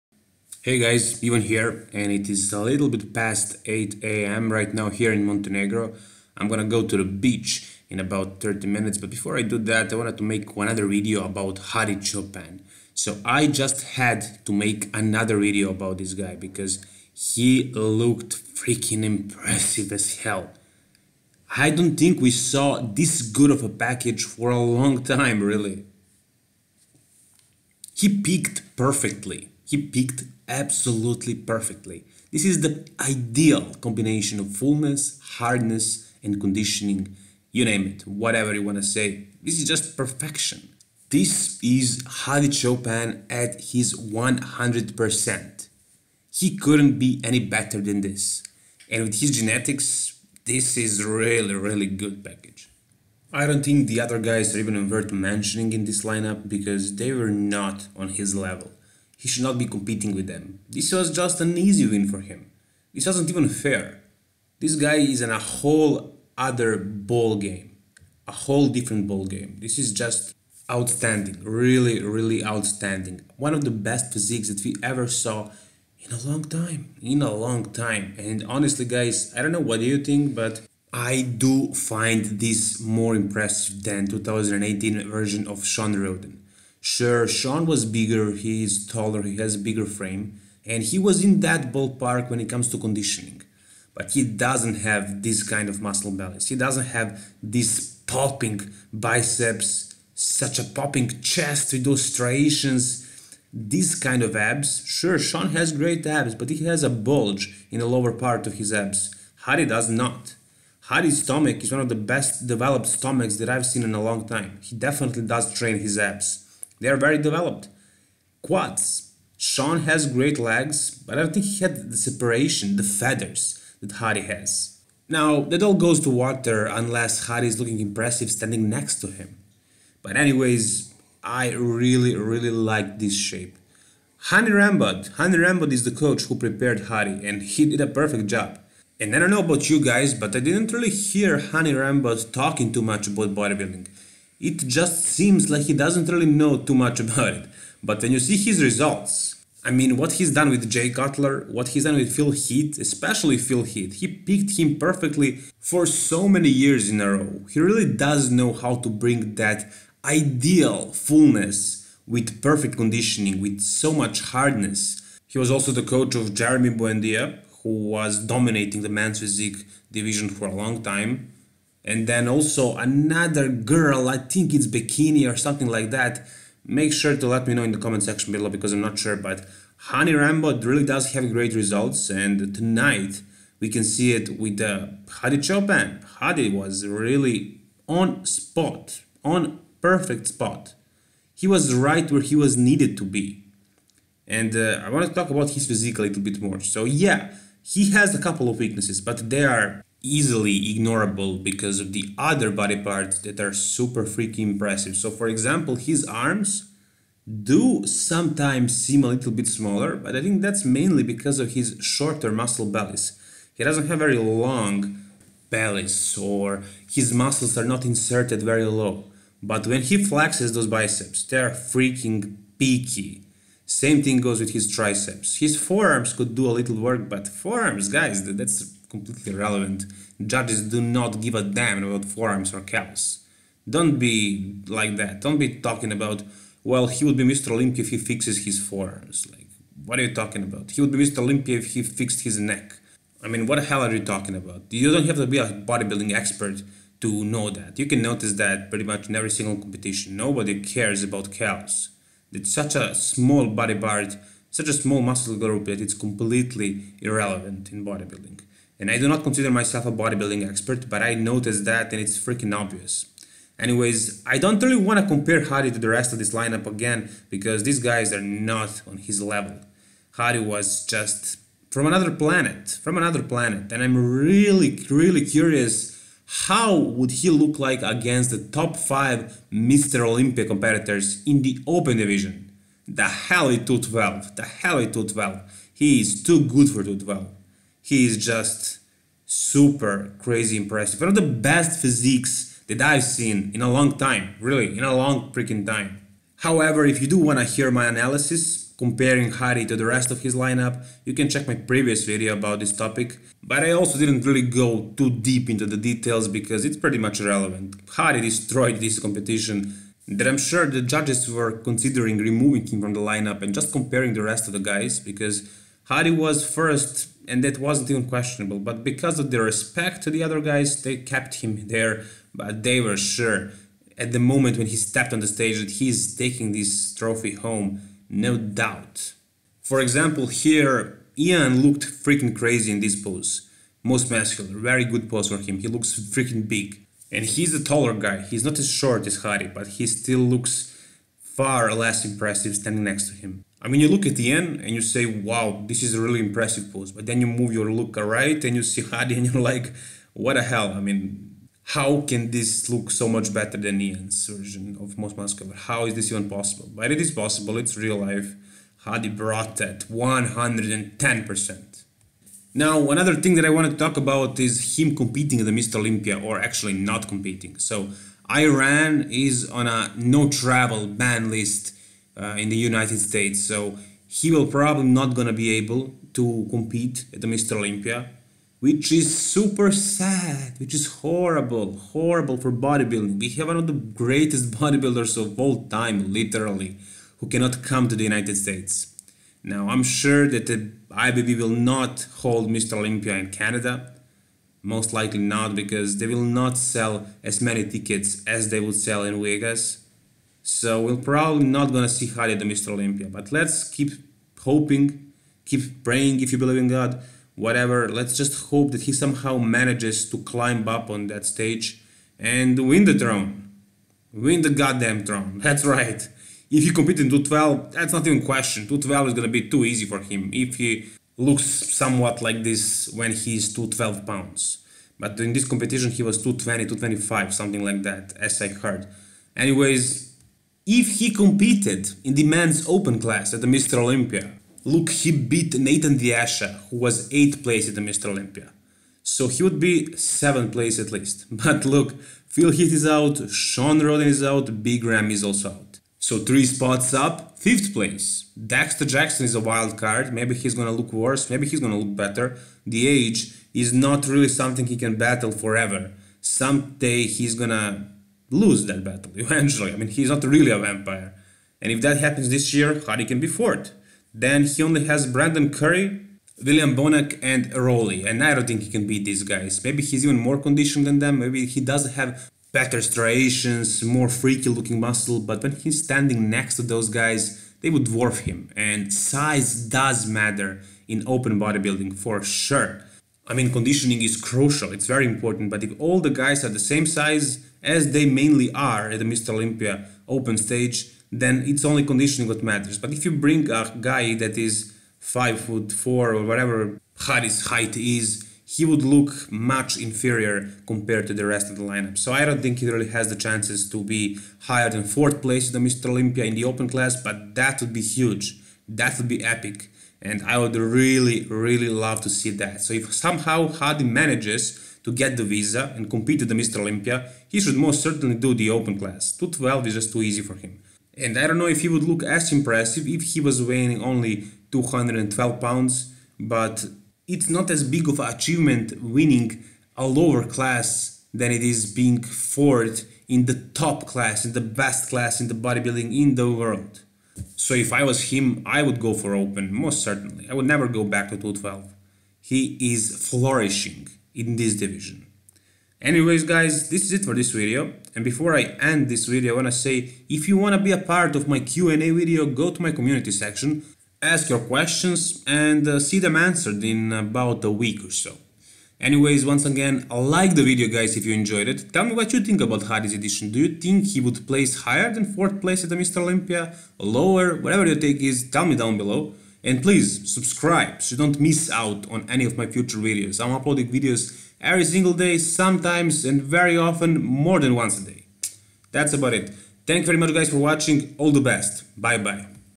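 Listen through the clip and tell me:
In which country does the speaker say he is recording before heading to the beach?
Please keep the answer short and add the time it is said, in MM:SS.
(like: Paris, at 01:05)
Montenegro, at 00:05.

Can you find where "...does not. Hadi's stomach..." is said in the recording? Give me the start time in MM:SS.
01:49.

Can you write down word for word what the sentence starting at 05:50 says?
I mean, how can this look so much better than Iain's version of Most Muscular?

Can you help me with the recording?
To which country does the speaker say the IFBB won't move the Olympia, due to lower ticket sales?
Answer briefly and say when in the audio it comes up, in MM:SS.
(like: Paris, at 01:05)
Canada, at 06:33.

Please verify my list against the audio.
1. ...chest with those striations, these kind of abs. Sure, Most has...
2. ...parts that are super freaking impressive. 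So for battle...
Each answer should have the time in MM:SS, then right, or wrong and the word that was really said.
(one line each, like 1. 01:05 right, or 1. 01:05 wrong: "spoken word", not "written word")
1. 01:41 wrong: "Shawn", not "Most"
2. 03:22 wrong: "example", not "battle".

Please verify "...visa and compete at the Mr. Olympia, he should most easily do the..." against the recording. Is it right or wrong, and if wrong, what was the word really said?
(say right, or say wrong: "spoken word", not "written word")
wrong: "certainly", not "easily".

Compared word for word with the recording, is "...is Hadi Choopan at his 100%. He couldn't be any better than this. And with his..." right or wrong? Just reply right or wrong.
right.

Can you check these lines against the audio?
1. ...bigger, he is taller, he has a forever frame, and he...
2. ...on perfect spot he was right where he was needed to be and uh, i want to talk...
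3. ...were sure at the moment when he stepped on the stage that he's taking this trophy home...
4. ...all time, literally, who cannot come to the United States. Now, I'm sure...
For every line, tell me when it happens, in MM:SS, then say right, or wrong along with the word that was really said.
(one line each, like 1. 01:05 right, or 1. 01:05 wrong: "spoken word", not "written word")
1. 01:27 wrong: "bigger", not "forever"
2. 03:09 right
3. 05:22 right
4. 06:25 right.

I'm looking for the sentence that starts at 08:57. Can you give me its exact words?
So if I was him, I would go for open, most certainly.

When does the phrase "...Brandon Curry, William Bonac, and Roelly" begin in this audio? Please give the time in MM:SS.
07:45.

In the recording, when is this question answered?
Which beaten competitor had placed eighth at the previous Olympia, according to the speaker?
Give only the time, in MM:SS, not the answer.
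07:15.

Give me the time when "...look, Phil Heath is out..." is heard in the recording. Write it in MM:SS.
07:21.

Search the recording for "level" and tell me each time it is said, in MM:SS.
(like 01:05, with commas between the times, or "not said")
00:58, 04:29.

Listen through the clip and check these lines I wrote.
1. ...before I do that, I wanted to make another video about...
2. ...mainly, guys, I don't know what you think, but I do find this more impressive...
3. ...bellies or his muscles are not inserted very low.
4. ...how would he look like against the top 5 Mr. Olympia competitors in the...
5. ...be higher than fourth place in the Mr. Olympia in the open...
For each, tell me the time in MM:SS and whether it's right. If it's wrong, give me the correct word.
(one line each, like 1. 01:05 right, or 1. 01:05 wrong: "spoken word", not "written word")
1. 00:09 right
2. 01:18 wrong: "honestly", not "mainly"
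3. 03:35 right
4. 04:36 right
5. 08:23 right.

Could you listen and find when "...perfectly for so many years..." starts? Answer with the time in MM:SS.
02:34.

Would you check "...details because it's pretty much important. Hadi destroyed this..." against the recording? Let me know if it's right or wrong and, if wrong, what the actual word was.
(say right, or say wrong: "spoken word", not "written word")
wrong: "irrelevant", not "important".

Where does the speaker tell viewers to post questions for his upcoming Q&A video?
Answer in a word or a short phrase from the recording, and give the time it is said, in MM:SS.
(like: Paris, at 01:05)
community section, at 09:12.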